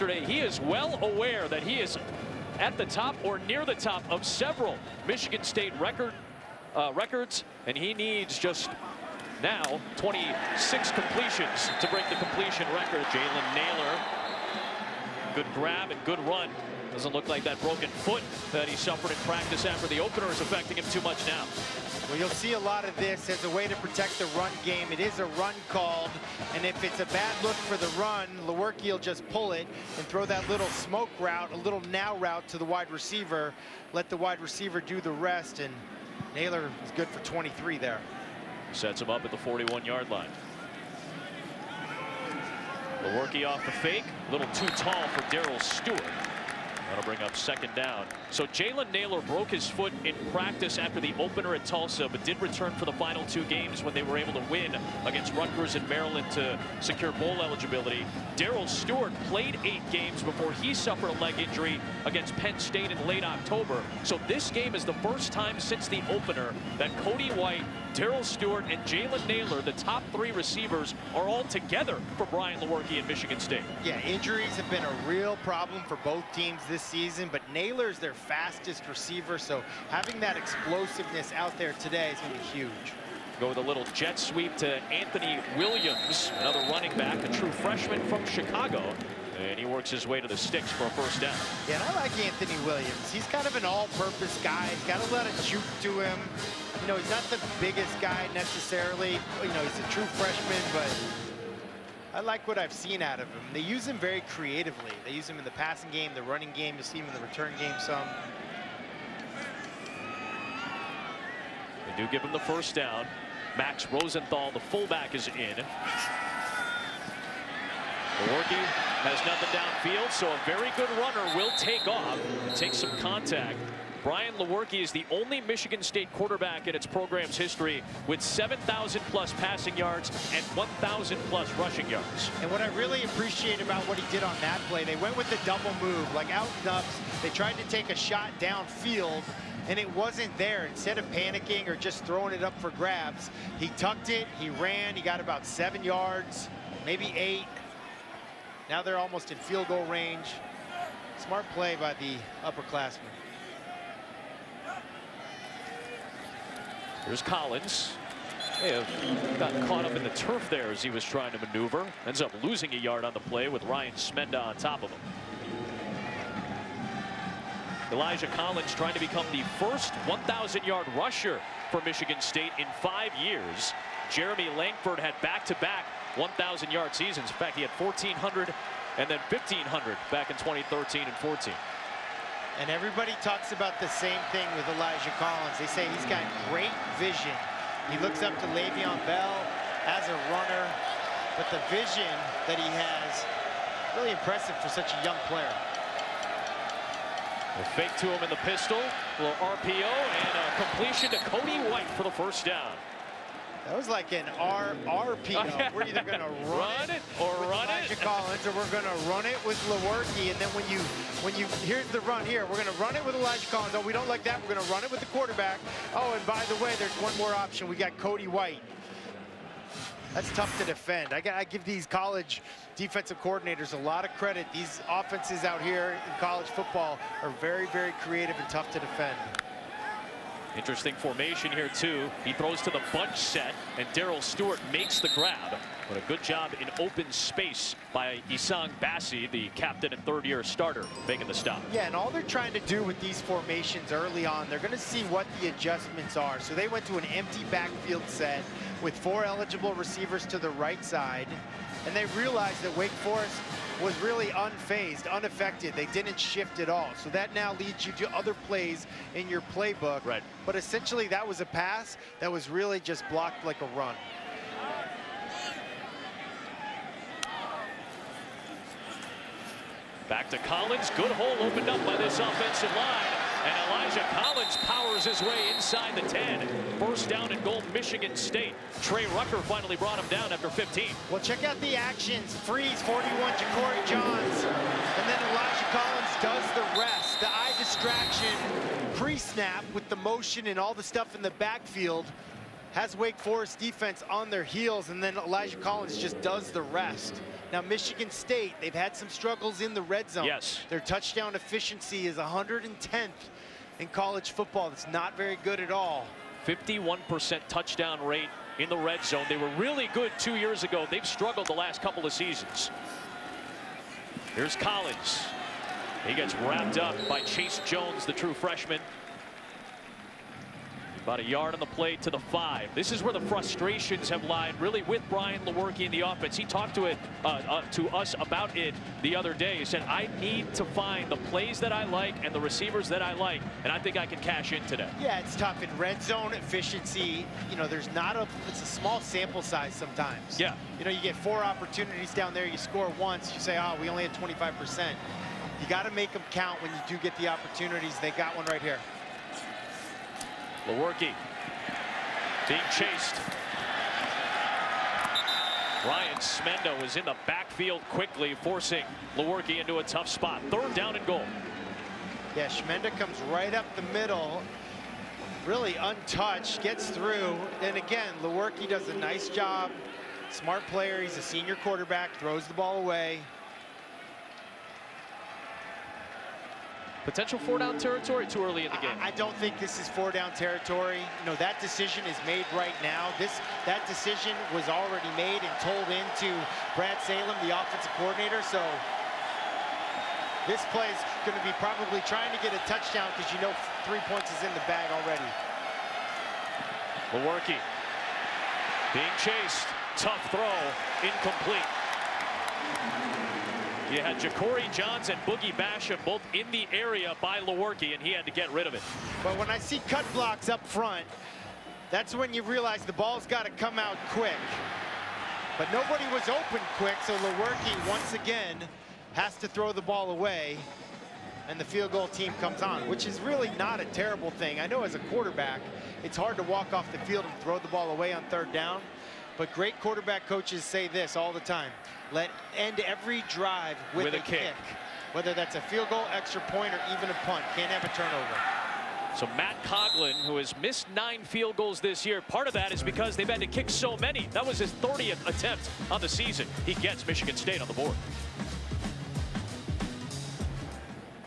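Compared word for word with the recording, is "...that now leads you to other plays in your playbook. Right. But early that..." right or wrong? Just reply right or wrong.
wrong.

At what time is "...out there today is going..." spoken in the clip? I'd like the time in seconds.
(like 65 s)
81 s.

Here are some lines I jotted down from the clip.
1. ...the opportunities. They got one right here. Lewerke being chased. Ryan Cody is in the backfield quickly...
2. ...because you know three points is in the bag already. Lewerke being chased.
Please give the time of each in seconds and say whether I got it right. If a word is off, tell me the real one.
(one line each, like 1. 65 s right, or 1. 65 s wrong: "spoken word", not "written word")
1. 347 s wrong: "Smenda", not "Cody"
2. 393 s right.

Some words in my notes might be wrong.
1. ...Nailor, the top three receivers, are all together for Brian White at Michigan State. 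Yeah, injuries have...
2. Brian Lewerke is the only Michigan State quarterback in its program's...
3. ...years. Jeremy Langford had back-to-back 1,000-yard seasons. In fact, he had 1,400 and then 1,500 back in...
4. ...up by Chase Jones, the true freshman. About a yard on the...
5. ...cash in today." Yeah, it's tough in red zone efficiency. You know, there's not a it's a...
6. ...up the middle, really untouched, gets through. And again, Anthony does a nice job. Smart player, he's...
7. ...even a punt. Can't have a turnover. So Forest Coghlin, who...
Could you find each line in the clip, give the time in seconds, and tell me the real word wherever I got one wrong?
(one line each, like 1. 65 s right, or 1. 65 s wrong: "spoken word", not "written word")
1. 69 s wrong: "Lewerke", not "White"
2. 124 s right
3. 173 s right
4. 316 s right
5. 334 s right
6. 363 s wrong: "Lewerke", not "Anthony"
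7. 436 s wrong: "Matt", not "Forest".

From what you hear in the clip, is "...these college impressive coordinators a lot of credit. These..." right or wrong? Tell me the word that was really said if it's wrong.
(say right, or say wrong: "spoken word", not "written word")
wrong: "defensive", not "impressive".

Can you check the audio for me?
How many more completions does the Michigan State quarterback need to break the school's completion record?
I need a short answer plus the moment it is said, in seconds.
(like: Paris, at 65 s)
26, at 9 s.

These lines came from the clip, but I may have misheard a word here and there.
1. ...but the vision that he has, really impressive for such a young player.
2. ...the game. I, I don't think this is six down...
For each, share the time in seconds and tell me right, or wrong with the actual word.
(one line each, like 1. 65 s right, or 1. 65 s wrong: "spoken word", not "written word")
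1. 191 s right
2. 378 s wrong: "four", not "six".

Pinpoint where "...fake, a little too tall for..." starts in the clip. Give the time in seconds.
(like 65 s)
43 s.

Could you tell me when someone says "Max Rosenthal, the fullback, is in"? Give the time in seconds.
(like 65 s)
113 s.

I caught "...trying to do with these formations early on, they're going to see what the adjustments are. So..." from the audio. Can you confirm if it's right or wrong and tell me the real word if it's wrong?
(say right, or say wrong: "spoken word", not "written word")
right.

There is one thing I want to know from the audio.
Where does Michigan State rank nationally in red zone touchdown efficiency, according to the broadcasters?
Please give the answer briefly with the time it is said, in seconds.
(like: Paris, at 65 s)
110th, at 302 s.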